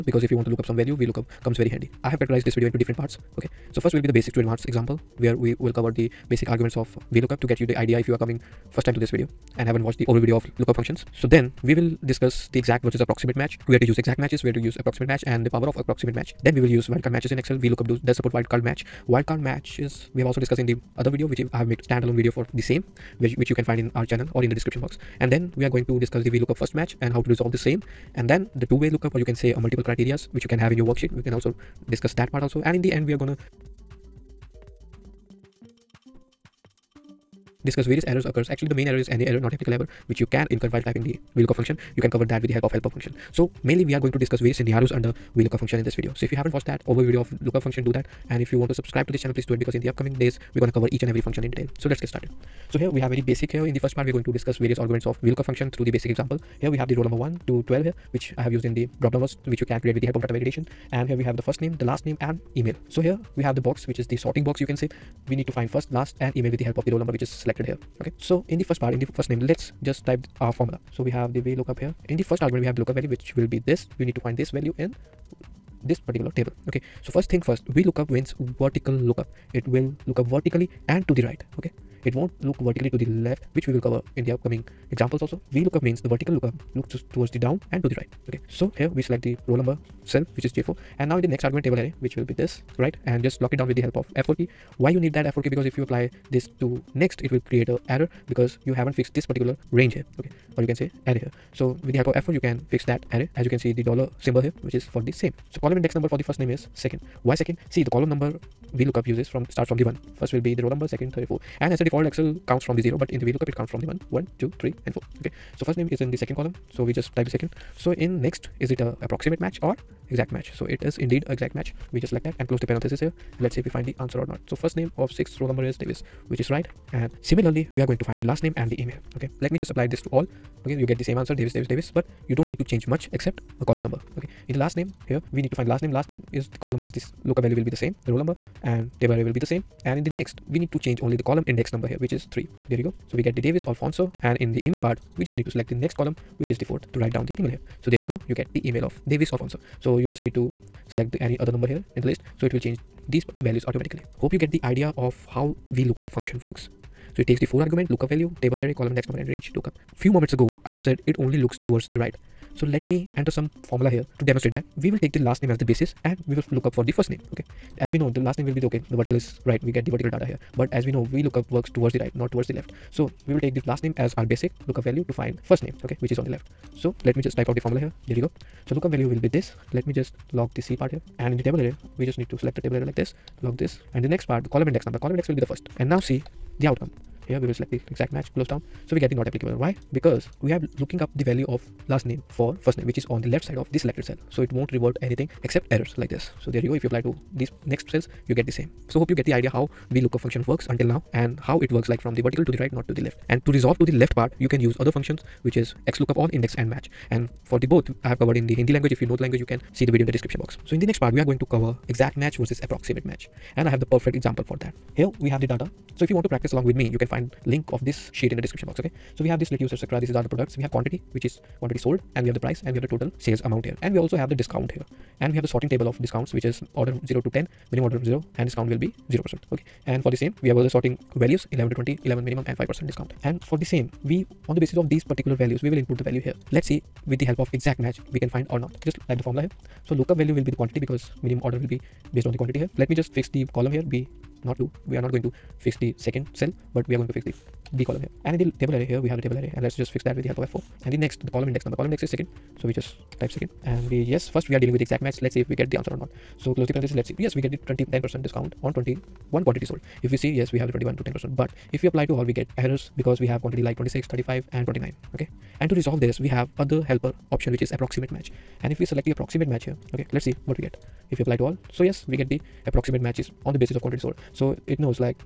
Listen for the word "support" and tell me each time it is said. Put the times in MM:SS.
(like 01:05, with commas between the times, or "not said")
00:18.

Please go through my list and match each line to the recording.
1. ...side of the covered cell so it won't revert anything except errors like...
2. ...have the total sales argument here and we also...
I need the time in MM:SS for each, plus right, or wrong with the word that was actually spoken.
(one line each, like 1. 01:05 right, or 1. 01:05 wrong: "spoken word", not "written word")
1. 03:13 wrong: "selected", not "covered"
2. 03:42 wrong: "amount", not "argument".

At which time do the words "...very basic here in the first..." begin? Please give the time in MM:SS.
00:53.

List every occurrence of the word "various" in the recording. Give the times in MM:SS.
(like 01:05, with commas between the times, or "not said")
00:37, 00:44, 00:54.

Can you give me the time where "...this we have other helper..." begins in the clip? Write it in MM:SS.
04:26.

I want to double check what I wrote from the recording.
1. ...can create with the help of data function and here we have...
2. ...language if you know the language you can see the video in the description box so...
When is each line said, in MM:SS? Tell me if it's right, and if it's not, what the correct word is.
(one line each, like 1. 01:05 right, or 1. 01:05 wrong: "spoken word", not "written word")
1. 00:59 wrong: "validation", not "function"
2. 03:28 right.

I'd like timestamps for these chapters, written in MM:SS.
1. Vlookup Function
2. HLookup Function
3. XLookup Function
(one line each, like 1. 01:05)
1. 00:35
2. 02:55
3. 03:57.